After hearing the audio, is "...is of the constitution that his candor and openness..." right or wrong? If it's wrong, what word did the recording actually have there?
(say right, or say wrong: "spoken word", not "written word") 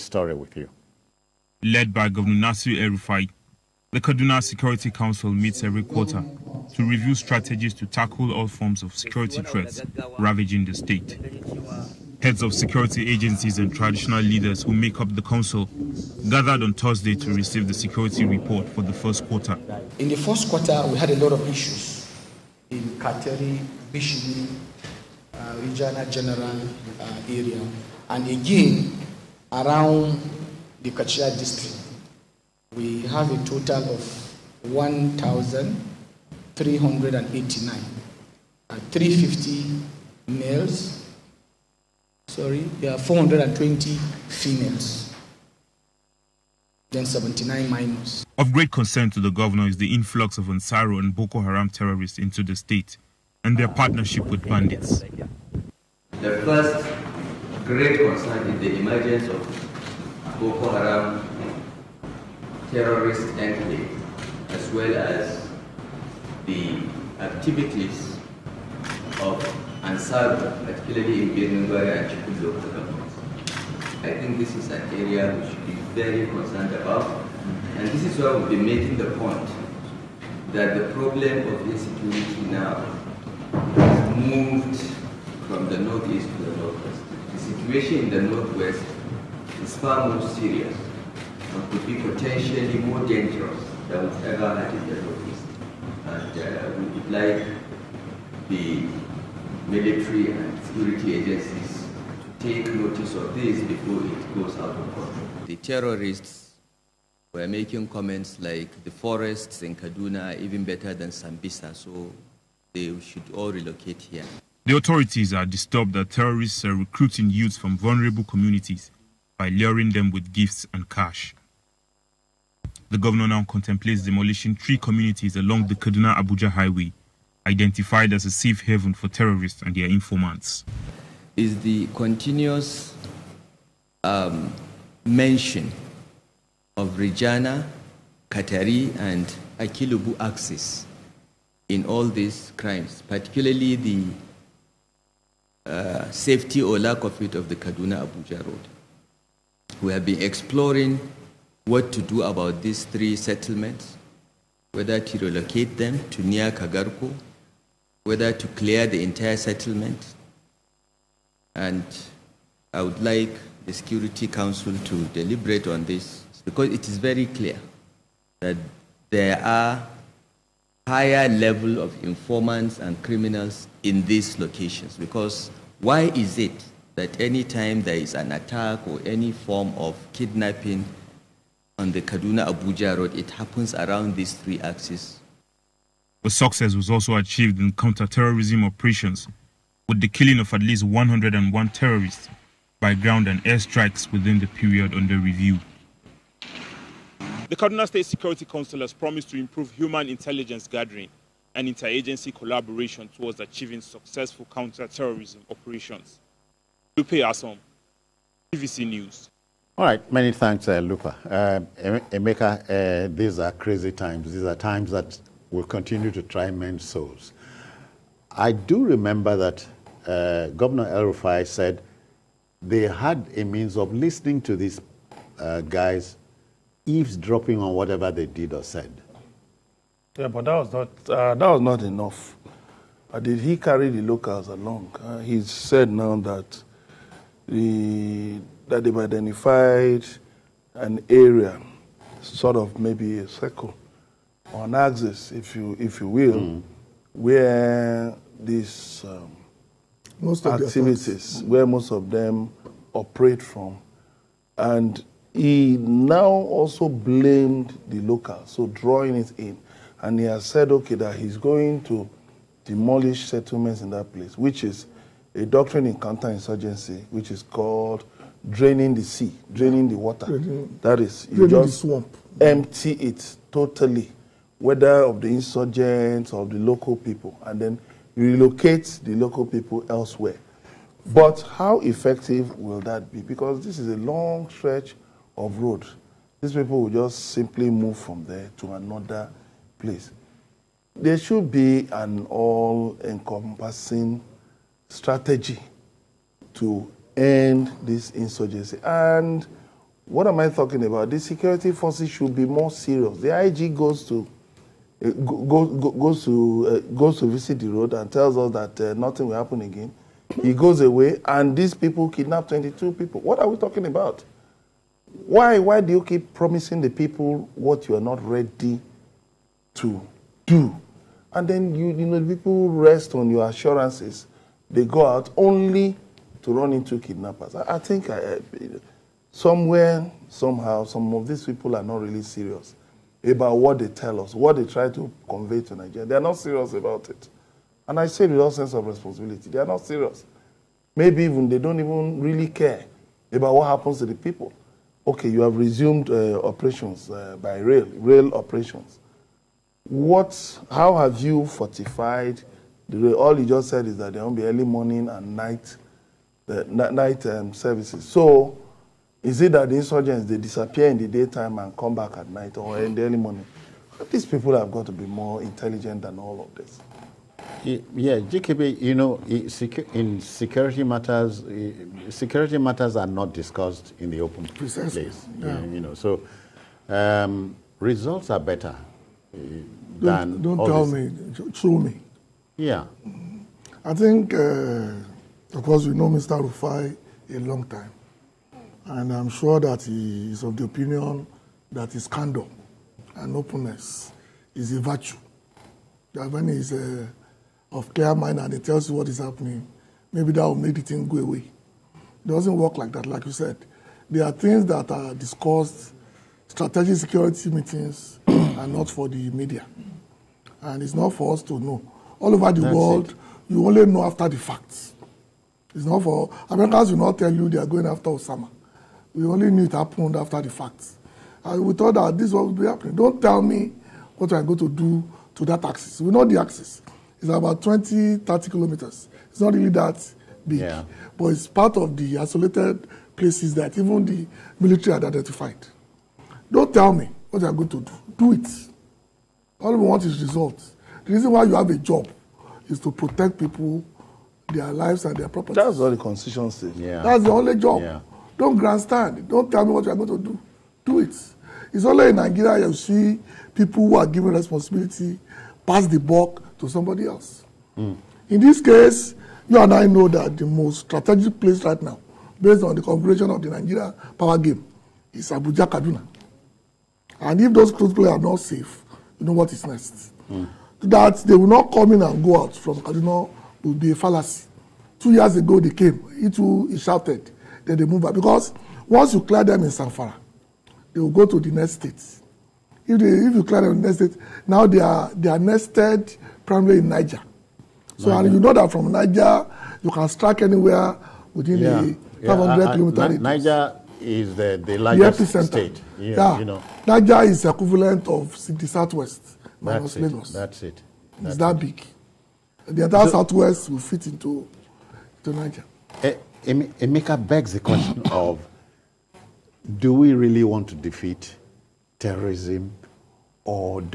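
wrong: "opinion", not "constitution".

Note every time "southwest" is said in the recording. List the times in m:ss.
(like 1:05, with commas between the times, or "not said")
8:18, 8:23.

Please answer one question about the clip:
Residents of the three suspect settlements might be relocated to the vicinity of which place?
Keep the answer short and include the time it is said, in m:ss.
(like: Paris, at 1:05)
Kagarko, at 2:36.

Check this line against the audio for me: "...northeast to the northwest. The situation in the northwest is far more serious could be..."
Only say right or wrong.
right.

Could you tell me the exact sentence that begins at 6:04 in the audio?
These people have got to be more intelligent than all of this.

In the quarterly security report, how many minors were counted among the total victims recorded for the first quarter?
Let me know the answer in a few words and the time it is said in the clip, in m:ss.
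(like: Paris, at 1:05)
79, at 0:47.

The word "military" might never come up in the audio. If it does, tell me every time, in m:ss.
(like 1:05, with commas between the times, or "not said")
1:39, 7:14.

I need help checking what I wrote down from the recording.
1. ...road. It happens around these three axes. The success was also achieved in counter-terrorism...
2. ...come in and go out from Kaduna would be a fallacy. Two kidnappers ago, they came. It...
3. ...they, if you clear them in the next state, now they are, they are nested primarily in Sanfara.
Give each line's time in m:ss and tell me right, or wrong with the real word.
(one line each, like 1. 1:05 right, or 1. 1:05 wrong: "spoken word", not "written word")
1. 3:02 right
2. 7:51 wrong: "years", not "kidnappers"
3. 8:02 wrong: "Niger", not "Sanfara".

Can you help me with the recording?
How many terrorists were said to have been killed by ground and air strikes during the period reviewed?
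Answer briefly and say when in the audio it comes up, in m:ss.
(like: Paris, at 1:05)
101, at 3:10.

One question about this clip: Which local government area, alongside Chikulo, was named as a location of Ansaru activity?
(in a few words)
Birnin-Gwari.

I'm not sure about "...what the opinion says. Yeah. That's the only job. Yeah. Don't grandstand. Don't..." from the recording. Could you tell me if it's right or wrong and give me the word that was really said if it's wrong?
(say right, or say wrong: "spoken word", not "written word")
wrong: "constitution", not "opinion".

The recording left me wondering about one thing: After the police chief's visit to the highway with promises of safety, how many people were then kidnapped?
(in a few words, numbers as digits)
22.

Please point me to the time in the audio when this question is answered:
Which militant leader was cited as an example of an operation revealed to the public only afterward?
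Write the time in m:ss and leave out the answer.
6:58.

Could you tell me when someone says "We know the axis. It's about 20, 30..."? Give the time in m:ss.
7:06.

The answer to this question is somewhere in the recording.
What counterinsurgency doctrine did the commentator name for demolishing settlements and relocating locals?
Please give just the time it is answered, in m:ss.
4:28.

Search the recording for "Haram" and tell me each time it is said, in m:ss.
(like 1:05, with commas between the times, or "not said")
0:51, 1:00.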